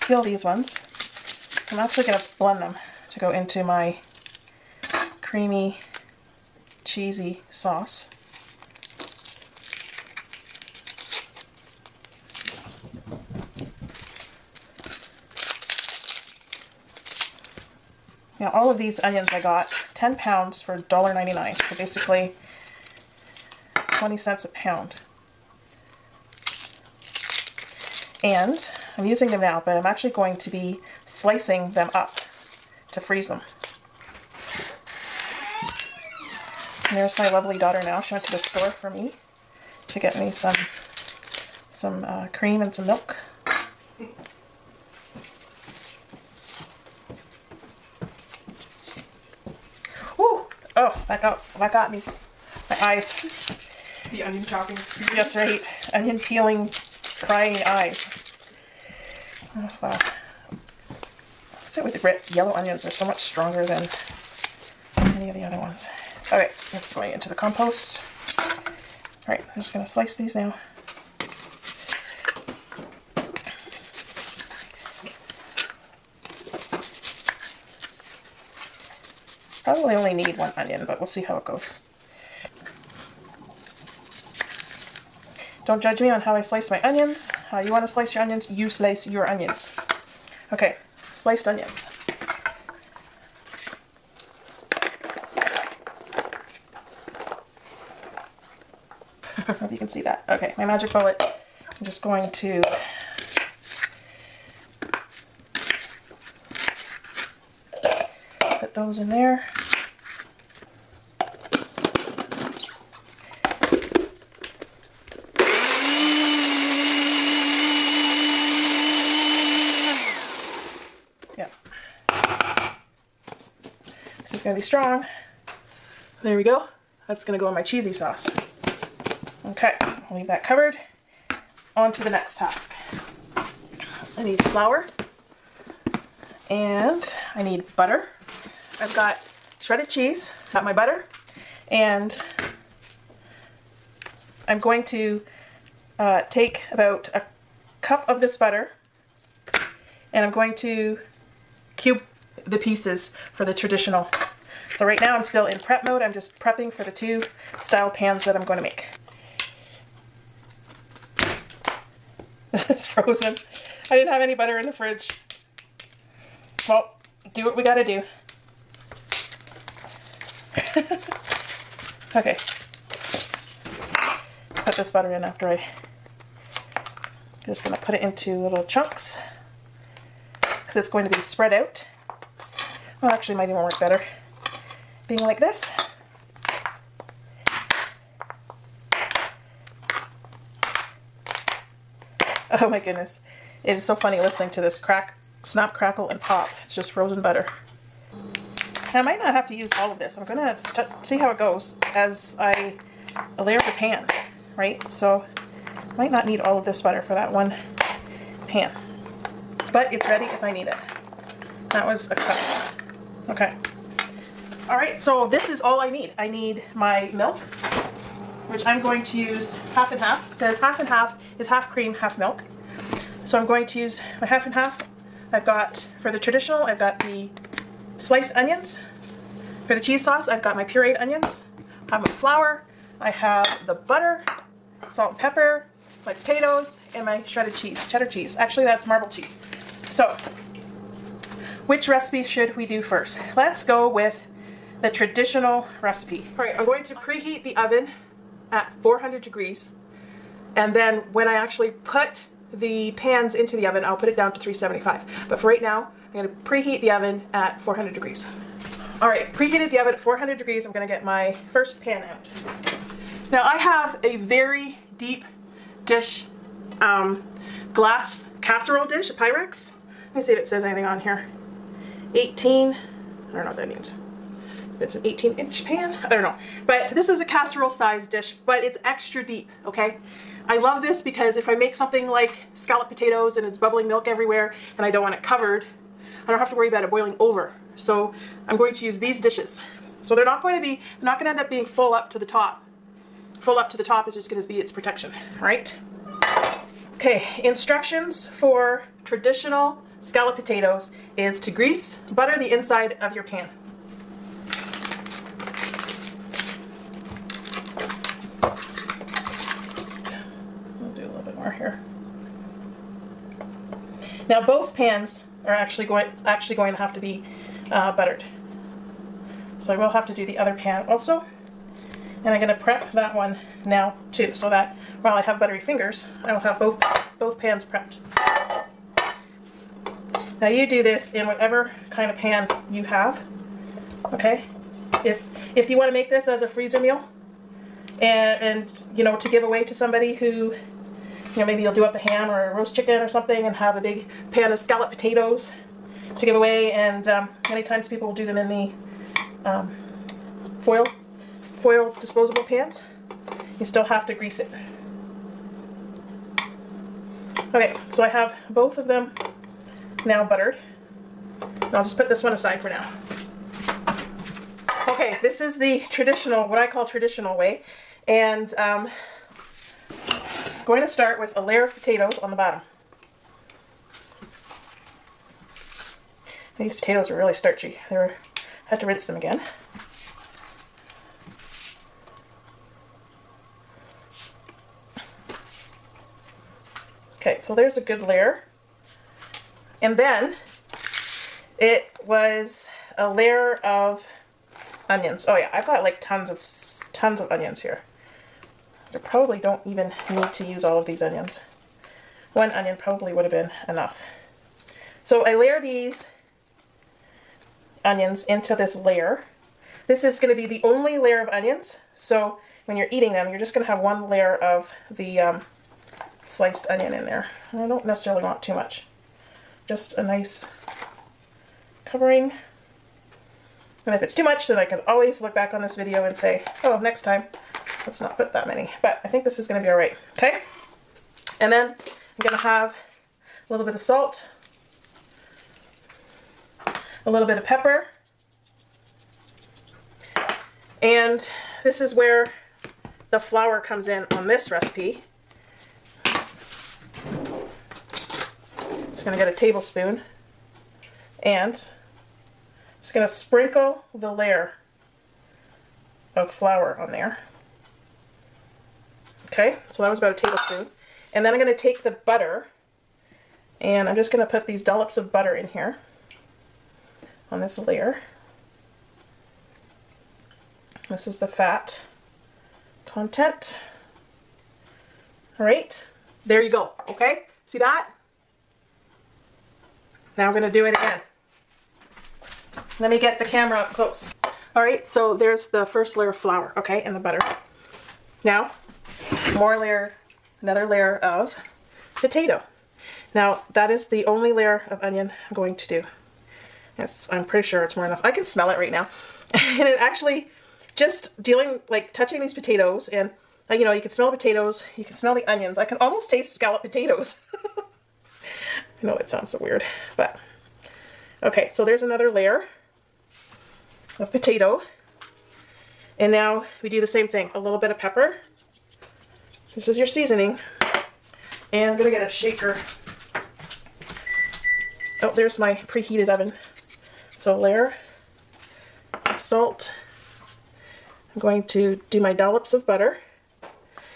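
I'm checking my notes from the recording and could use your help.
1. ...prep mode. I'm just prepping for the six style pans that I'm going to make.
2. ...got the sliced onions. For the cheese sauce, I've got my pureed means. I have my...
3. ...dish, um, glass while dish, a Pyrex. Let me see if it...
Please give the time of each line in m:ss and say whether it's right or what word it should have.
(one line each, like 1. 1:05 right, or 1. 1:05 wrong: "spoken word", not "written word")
1. 2:35 wrong: "two", not "six"
2. 3:46 wrong: "onions", not "means"
3. 4:25 wrong: "casserole", not "while".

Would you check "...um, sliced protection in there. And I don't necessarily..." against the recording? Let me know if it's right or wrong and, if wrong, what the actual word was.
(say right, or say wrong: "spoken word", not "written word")
wrong: "onion", not "protection".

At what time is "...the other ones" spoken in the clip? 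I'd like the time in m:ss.
1:05.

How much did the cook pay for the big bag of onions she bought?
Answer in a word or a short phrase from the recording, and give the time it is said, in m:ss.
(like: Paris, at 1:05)
$1.99, at 0:20.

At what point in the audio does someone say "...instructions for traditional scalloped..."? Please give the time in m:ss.
4:57.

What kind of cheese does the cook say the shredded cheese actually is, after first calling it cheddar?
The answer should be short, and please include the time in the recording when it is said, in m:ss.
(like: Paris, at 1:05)
marble cheese, at 3:58.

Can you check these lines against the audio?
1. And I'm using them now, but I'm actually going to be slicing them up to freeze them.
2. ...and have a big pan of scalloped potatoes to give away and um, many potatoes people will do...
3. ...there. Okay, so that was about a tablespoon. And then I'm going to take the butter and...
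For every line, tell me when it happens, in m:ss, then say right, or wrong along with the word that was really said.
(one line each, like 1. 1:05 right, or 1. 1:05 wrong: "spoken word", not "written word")
1. 0:28 right
2. 5:43 wrong: "times", not "potatoes"
3. 7:36 right.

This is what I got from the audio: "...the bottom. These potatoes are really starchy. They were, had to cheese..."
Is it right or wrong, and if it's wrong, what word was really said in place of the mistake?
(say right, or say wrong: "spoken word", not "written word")
wrong: "rinse", not "cheese".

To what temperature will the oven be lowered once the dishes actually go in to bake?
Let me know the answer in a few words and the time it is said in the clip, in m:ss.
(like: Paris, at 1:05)
375, at 4:14.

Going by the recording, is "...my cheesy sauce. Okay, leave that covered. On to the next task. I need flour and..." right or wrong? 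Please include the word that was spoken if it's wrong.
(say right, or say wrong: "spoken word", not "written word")
right.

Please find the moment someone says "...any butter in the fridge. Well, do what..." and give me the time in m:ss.
2:44.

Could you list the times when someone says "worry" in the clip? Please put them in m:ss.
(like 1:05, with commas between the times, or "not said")
4:46.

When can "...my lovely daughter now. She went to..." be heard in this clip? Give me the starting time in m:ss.
0:37.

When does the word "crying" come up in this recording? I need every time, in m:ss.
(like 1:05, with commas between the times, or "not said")
0:57.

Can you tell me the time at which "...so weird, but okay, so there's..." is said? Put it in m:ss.
8:29.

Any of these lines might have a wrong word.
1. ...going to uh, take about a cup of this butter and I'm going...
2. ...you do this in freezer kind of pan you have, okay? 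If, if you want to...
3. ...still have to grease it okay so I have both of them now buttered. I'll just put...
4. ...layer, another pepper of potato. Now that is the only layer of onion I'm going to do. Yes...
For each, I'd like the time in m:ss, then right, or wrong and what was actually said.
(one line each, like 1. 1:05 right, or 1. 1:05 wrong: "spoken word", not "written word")
1. 2:24 right
2. 5:30 wrong: "whatever", not "freezer"
3. 5:53 right
4. 8:09 wrong: "layer", not "pepper".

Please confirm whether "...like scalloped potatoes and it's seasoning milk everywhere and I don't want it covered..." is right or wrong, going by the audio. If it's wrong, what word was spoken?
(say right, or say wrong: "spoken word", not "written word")
wrong: "bubbling", not "seasoning".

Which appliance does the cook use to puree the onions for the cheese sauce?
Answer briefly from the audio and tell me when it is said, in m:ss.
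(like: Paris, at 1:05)
Magic Bullet, at 1:40.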